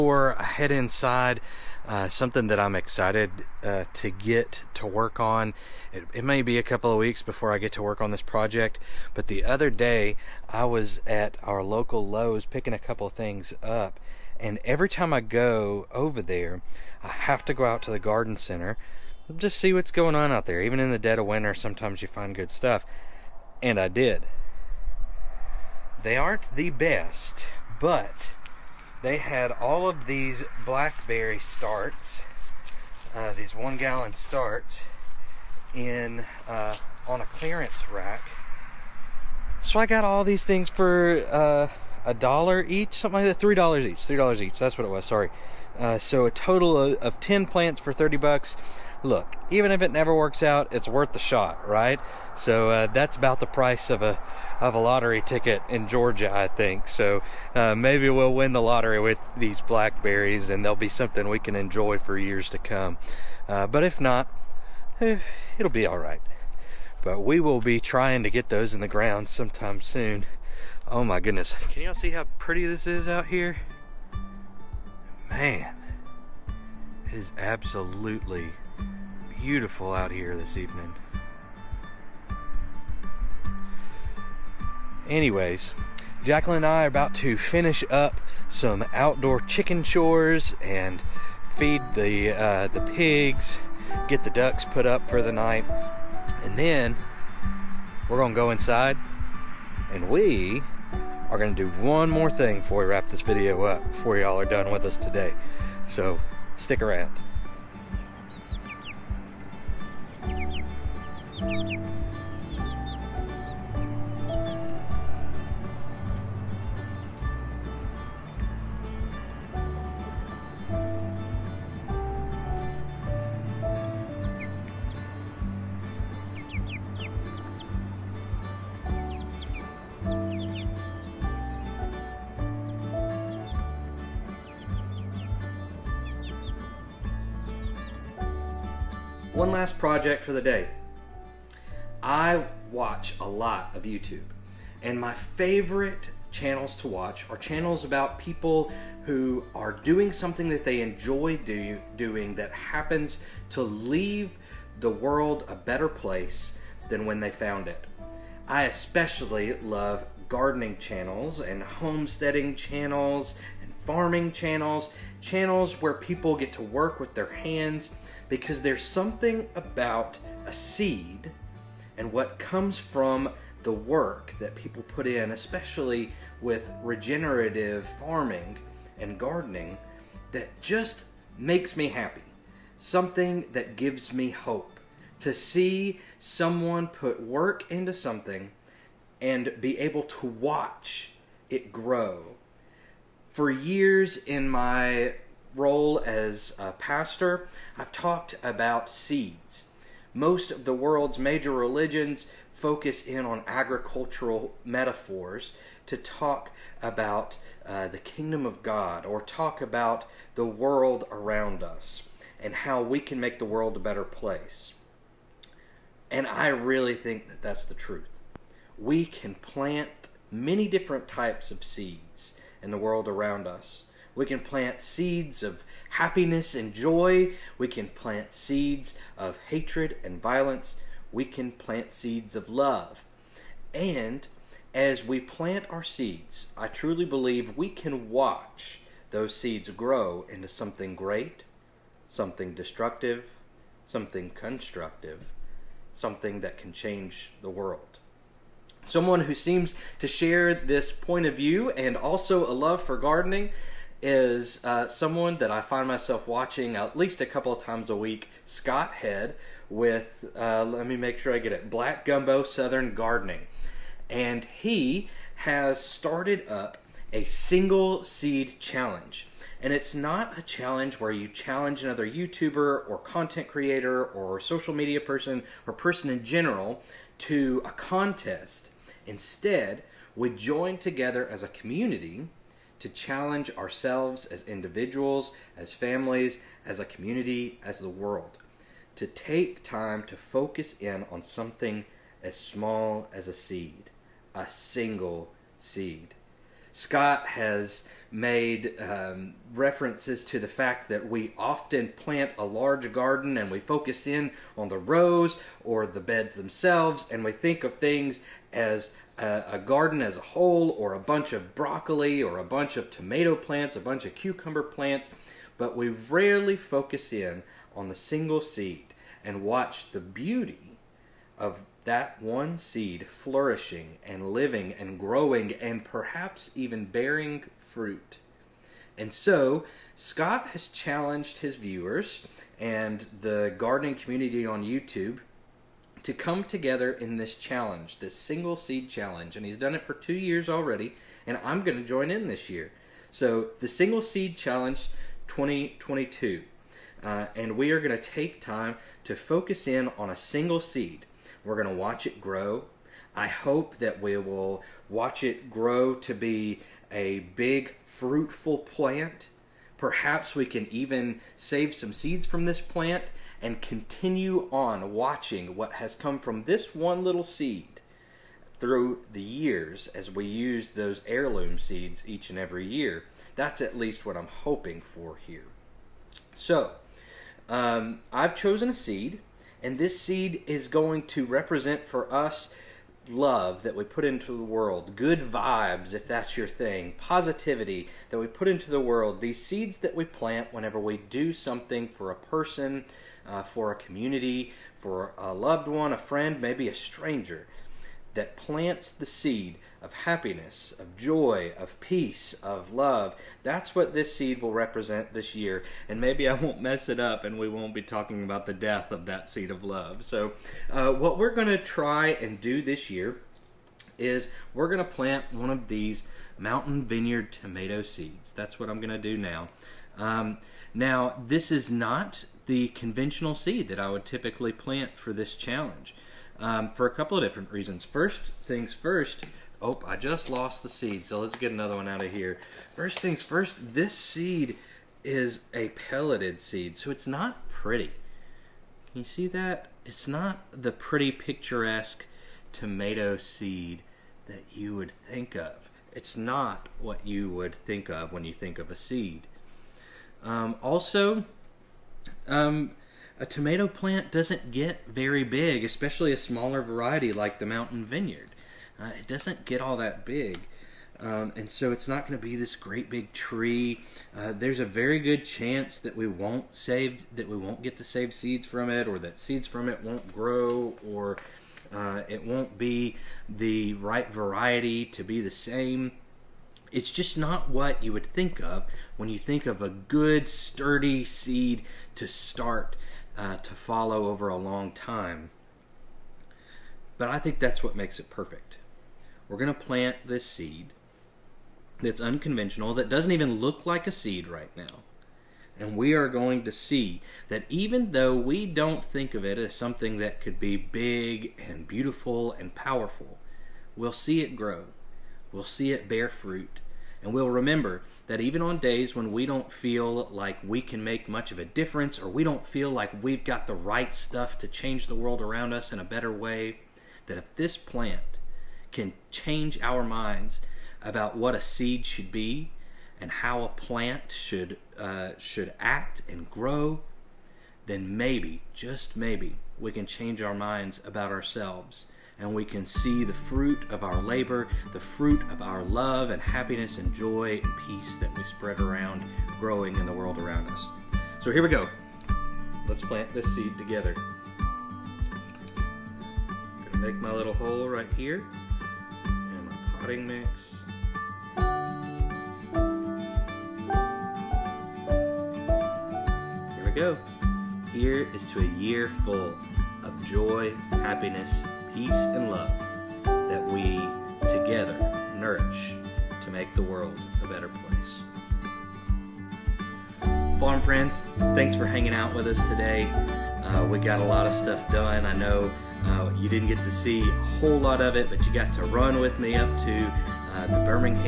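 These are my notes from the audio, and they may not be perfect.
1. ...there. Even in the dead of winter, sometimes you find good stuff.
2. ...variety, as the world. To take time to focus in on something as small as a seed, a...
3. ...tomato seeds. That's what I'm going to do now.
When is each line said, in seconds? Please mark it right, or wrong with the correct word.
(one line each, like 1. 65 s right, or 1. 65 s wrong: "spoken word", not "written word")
1. 20 s right
2. 286 s wrong: "community", not "variety"
3. 417 s right.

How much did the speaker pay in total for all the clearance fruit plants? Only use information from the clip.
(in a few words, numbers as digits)
30 bucks.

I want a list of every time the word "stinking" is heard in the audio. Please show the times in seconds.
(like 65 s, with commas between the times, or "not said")
not said.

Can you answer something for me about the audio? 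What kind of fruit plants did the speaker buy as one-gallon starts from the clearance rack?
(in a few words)
Blackberry.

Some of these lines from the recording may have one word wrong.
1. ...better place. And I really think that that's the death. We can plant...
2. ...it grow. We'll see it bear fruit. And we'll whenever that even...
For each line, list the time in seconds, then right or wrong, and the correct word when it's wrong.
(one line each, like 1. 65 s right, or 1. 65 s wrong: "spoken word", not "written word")
1. 213 s wrong: "truth", not "death"
2. 504 s wrong: "remember", not "whenever".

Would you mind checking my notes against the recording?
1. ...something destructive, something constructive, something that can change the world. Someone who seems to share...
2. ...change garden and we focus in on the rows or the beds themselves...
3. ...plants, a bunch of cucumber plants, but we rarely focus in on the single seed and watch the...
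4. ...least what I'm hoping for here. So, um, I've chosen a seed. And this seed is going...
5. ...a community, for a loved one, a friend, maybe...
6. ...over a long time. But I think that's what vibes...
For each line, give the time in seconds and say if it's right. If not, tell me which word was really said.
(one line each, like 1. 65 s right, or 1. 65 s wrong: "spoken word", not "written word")
1. 242 s right
2. 302 s wrong: "large", not "change"
3. 313 s right
4. 373 s right
5. 393 s right
6. 484 s wrong: "makes", not "vibes".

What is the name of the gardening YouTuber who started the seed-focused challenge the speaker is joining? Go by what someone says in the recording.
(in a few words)
Scott Head.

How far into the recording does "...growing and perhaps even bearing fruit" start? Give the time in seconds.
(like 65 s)
324 s.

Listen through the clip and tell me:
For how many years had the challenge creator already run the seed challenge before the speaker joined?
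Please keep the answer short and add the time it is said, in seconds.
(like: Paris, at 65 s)
2, at 339 s.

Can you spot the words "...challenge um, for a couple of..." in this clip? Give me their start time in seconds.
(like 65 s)
425 s.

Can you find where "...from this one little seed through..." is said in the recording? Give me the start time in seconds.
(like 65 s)
366 s.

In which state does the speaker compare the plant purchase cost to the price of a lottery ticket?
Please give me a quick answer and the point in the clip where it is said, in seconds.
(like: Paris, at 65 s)
Georgia, at 55 s.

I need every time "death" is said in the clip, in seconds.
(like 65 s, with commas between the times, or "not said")
408 s.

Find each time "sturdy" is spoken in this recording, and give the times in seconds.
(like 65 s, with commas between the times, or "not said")
480 s.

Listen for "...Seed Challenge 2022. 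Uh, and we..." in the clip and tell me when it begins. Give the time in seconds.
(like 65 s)
344 s.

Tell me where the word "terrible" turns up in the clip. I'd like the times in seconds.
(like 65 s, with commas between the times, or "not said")
not said.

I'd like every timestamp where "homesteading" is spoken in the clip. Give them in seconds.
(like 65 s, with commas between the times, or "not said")
161 s.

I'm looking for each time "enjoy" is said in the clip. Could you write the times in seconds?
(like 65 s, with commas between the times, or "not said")
61 s, 150 s.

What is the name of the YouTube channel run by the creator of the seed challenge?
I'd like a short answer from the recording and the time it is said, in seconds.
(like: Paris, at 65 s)
Black Gumbo Southern Gardening, at 261 s.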